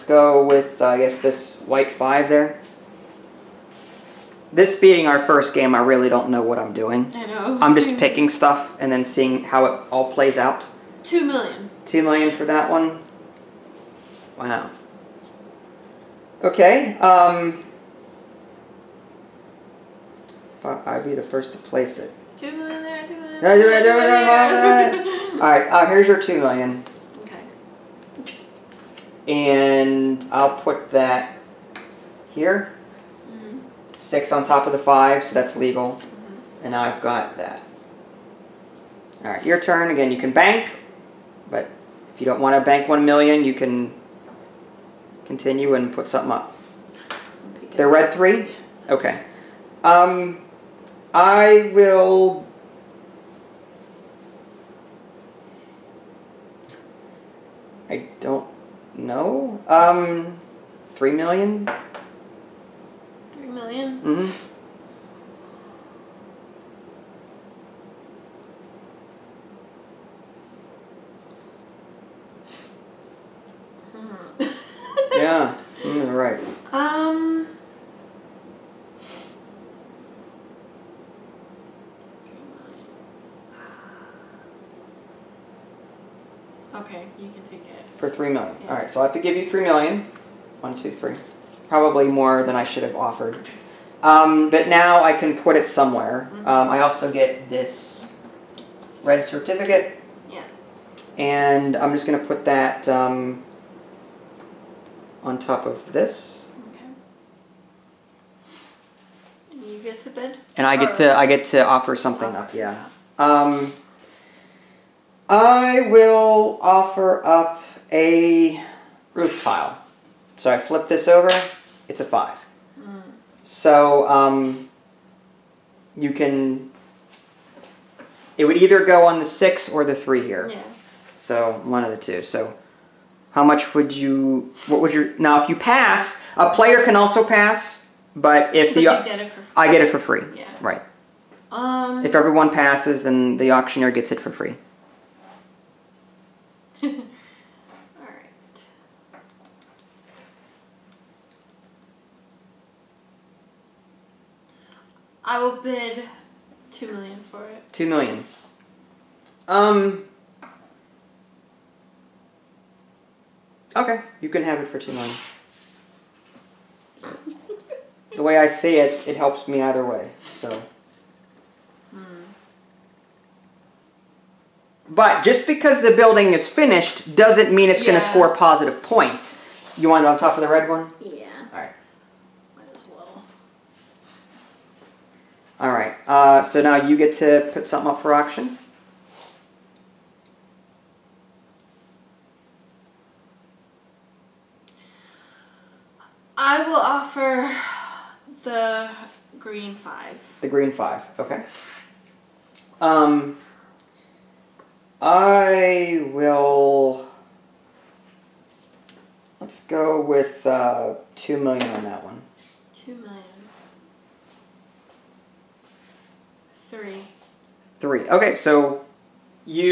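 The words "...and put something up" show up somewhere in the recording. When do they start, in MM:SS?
00:45.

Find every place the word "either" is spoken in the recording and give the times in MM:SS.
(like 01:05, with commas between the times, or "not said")
02:08, 02:49.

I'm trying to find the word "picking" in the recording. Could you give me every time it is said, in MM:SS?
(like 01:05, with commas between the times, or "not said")
00:07.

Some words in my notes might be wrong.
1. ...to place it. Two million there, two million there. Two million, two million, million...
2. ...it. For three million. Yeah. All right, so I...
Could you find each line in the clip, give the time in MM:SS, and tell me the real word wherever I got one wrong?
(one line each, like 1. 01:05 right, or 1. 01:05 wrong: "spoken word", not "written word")
1. 00:21 right
2. 01:27 right.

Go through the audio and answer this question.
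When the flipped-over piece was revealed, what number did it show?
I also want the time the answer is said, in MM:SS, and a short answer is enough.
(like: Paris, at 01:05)
5, at 02:01.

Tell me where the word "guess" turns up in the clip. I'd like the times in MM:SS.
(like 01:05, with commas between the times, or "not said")
00:00.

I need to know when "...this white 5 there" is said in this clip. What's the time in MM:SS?
00:01.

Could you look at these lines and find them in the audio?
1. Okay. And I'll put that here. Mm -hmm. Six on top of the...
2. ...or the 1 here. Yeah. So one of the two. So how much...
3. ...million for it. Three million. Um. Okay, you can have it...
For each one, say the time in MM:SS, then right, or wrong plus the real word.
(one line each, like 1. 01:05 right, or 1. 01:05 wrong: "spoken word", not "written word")
1. 00:27 right
2. 02:09 wrong: "3", not "1"
3. 02:36 wrong: "Two", not "Three".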